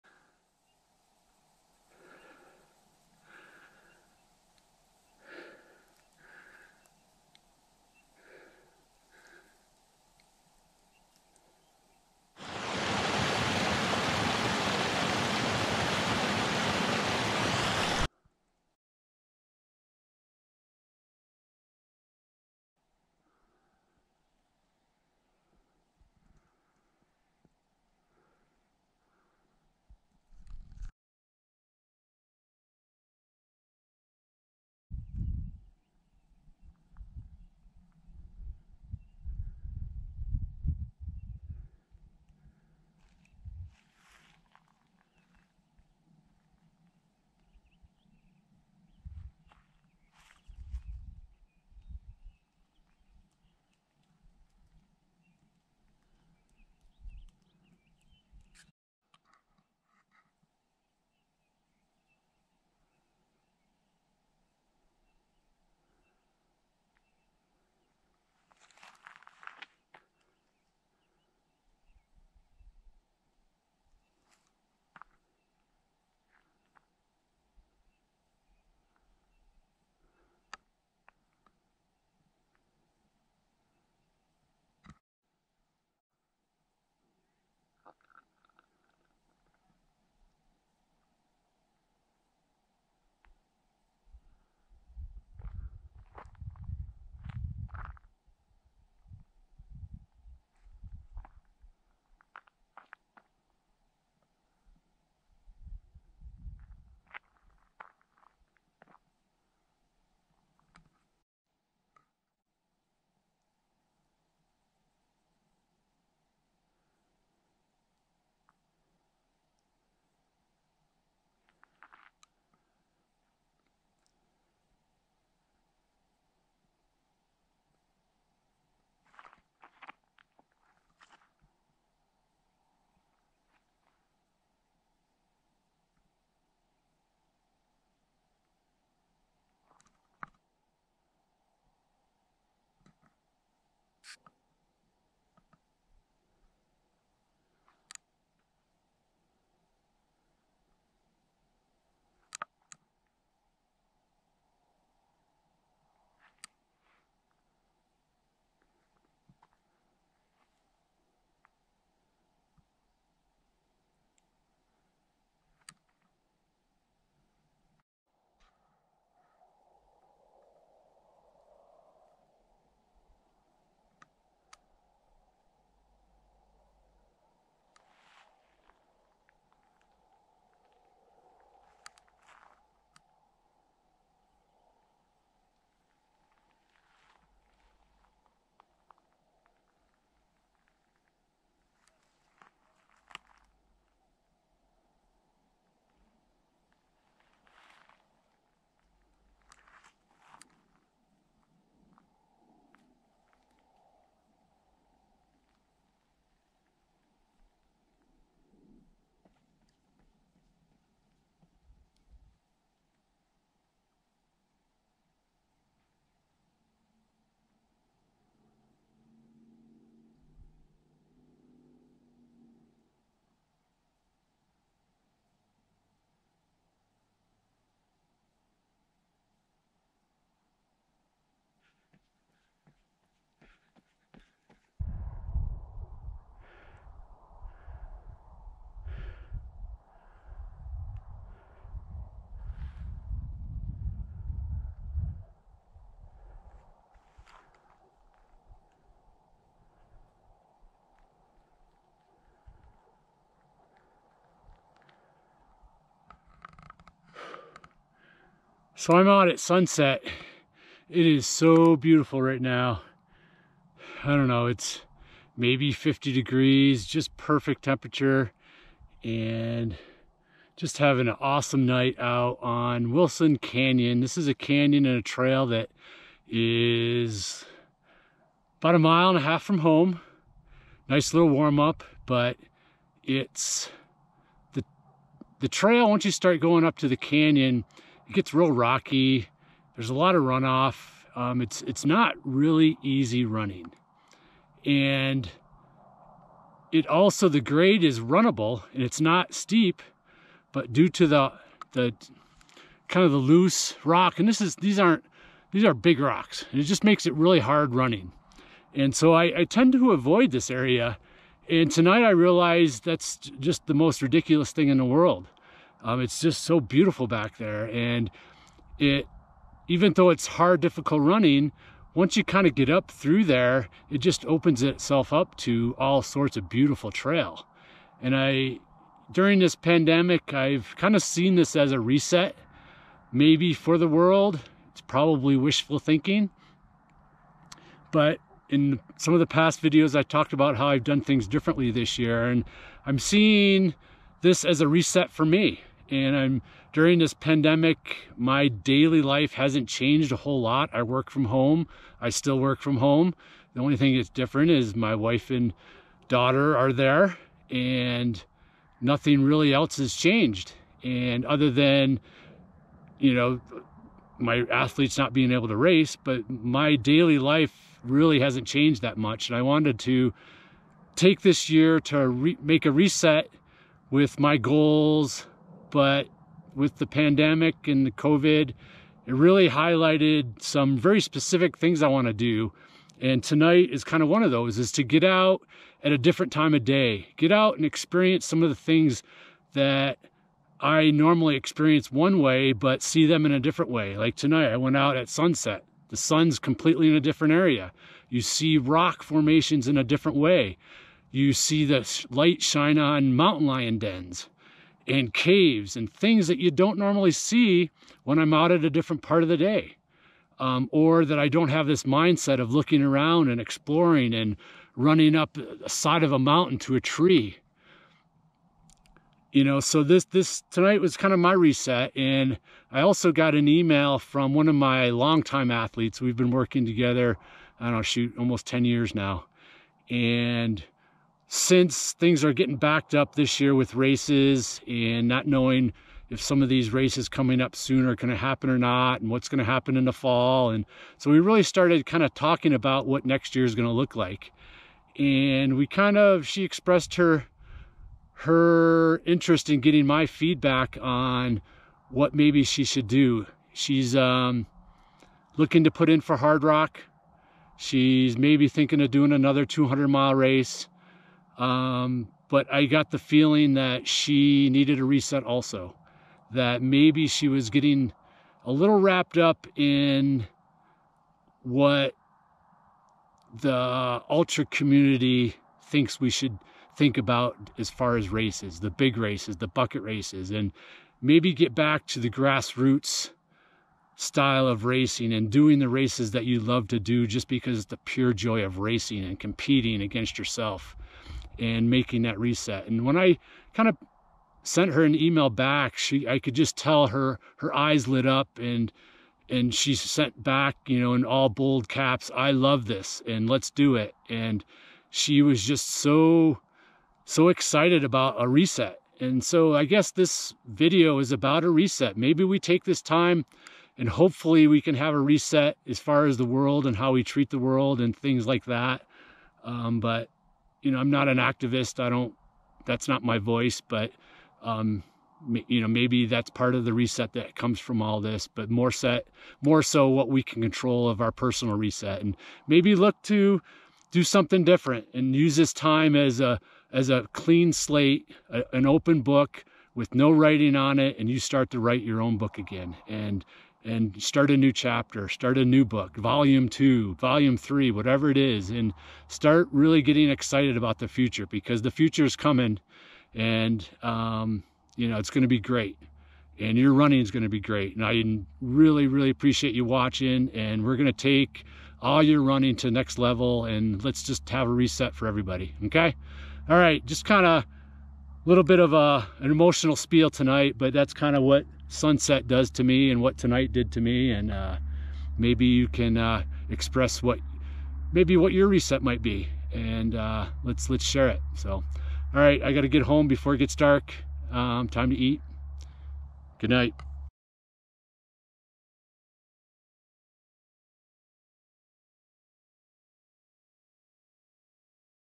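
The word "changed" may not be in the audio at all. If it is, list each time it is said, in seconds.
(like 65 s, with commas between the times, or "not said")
349 s, 359 s, 368 s.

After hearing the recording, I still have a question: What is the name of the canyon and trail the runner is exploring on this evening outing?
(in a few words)
Wilson Canyon.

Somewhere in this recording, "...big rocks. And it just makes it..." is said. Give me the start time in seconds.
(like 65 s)
305 s.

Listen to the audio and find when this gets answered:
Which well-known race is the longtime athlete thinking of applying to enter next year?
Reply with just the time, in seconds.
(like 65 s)
456 s.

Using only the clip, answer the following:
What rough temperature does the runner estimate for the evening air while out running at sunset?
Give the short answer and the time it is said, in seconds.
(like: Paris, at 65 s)
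50 degrees, at 265 s.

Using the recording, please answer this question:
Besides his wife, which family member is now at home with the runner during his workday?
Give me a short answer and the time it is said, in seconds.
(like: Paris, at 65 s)
daughter, at 356 s.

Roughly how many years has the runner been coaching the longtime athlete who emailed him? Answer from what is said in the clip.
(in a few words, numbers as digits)
almost 10 years.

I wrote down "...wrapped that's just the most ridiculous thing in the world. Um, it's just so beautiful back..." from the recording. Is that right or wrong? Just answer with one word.
wrong.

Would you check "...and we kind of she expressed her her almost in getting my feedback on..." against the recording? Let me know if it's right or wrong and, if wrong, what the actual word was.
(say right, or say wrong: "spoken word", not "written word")
wrong: "interest", not "almost".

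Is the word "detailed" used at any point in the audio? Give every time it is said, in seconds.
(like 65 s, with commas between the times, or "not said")
not said.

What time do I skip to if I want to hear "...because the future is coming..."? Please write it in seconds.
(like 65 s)
551 s.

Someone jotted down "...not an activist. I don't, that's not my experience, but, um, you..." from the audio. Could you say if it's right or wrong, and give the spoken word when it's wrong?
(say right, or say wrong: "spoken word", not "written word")
wrong: "voice", not "experience".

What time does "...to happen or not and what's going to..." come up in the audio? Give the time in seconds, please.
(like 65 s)
438 s.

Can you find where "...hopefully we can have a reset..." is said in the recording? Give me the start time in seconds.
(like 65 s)
513 s.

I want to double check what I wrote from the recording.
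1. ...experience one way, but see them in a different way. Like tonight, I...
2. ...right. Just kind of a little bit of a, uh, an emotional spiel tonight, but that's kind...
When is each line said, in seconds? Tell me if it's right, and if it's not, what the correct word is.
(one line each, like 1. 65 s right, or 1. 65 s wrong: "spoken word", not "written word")
1. 391 s right
2. 566 s right.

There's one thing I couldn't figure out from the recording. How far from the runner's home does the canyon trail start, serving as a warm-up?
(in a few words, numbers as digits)
a mile and a half.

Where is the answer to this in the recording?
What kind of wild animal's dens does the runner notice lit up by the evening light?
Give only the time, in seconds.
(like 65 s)
403 s.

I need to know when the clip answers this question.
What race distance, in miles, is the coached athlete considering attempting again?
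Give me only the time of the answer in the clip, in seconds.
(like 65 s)
459 s.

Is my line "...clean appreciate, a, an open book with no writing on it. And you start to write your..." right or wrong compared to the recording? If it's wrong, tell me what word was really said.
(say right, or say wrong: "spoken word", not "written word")
wrong: "slate", not "appreciate".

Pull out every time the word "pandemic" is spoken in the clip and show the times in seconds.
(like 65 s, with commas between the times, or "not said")
329 s, 347 s, 376 s.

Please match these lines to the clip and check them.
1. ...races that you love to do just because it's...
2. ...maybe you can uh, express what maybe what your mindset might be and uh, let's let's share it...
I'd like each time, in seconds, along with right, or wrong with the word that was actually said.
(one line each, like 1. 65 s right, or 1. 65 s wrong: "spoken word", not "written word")
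1. 485 s right
2. 575 s wrong: "reset", not "mindset".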